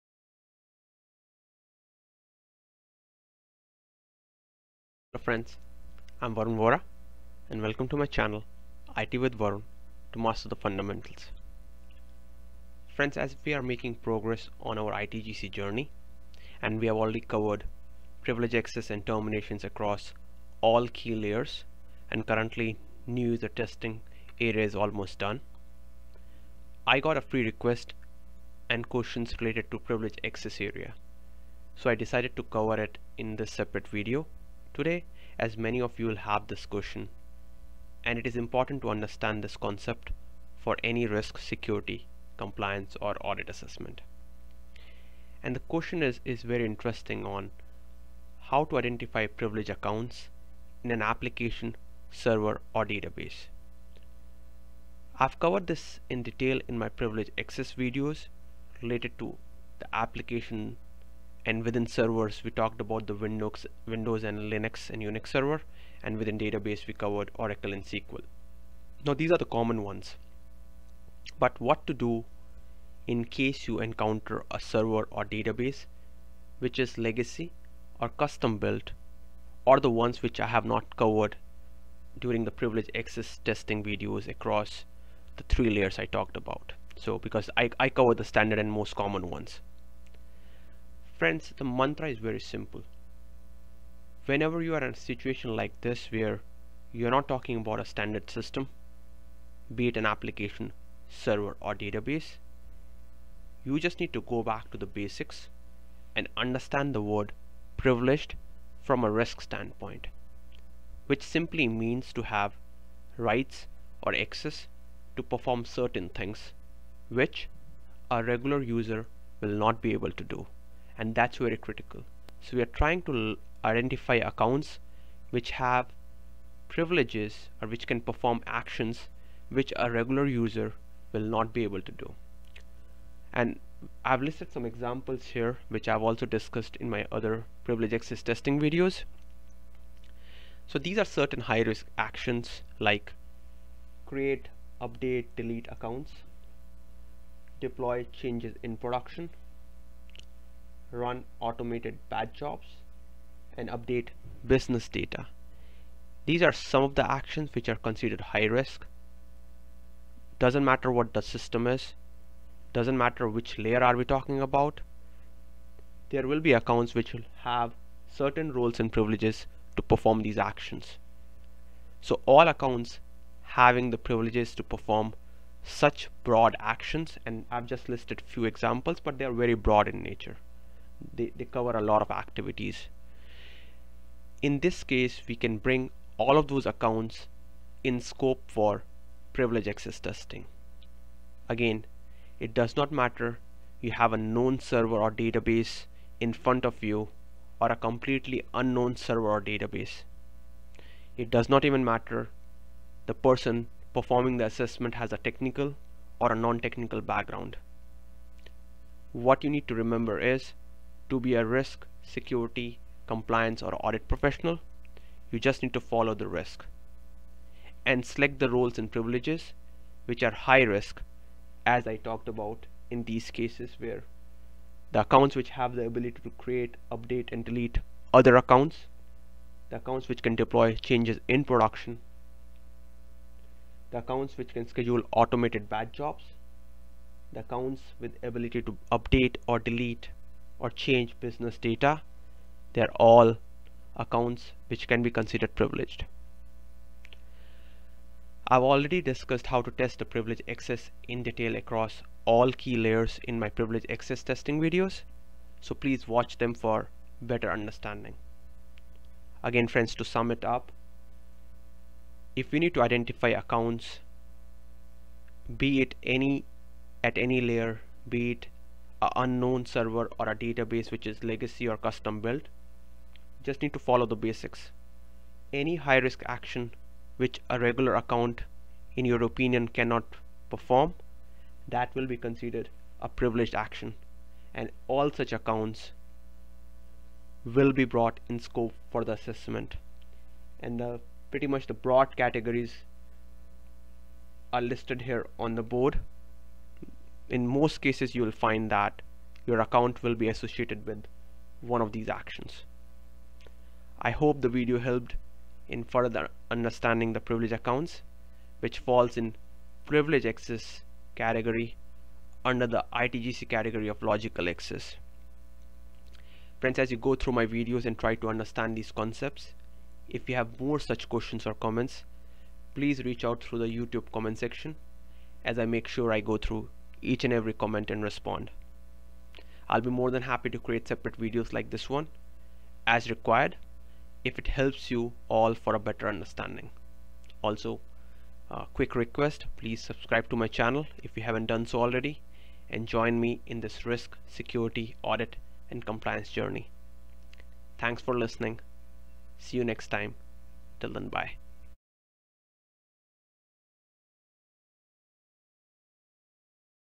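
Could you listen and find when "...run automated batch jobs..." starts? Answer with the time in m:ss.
2:30.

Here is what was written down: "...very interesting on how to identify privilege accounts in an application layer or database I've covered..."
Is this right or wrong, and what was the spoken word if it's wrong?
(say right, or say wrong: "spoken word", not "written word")
wrong: "server", not "layer".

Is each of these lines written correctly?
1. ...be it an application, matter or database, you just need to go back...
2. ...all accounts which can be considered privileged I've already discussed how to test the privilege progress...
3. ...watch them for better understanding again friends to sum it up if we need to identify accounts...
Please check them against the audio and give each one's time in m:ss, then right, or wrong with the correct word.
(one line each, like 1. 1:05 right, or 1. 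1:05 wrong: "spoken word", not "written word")
1. 1:39 wrong: "server", not "matter"
2. 4:03 wrong: "access", not "progress"
3. 4:16 right.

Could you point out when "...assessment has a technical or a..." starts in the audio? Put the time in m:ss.
3:24.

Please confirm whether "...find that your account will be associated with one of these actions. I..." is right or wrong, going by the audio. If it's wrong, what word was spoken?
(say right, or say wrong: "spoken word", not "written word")
right.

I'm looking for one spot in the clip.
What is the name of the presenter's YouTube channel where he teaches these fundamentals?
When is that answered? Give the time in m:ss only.
0:08.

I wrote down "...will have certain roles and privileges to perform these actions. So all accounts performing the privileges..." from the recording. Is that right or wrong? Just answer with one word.
wrong.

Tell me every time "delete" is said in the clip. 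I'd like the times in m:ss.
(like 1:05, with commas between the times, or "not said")
2:25, 3:47, 3:59.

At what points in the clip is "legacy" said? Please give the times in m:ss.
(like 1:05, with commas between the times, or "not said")
1:16, 4:31.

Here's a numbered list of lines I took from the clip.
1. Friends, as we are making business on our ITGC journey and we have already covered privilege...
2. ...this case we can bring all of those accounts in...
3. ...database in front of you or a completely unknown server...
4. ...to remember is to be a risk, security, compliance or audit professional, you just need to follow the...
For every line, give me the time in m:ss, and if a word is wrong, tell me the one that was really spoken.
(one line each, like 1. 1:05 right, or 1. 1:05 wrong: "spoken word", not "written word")
1. 0:12 wrong: "progress", not "business"
2. 3:04 right
3. 3:15 right
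4. 3:29 right.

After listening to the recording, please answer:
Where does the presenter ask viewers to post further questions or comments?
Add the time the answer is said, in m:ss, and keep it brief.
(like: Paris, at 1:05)
YouTube comment section, at 5:23.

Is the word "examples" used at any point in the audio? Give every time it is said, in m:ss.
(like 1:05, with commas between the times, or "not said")
2:14, 2:58.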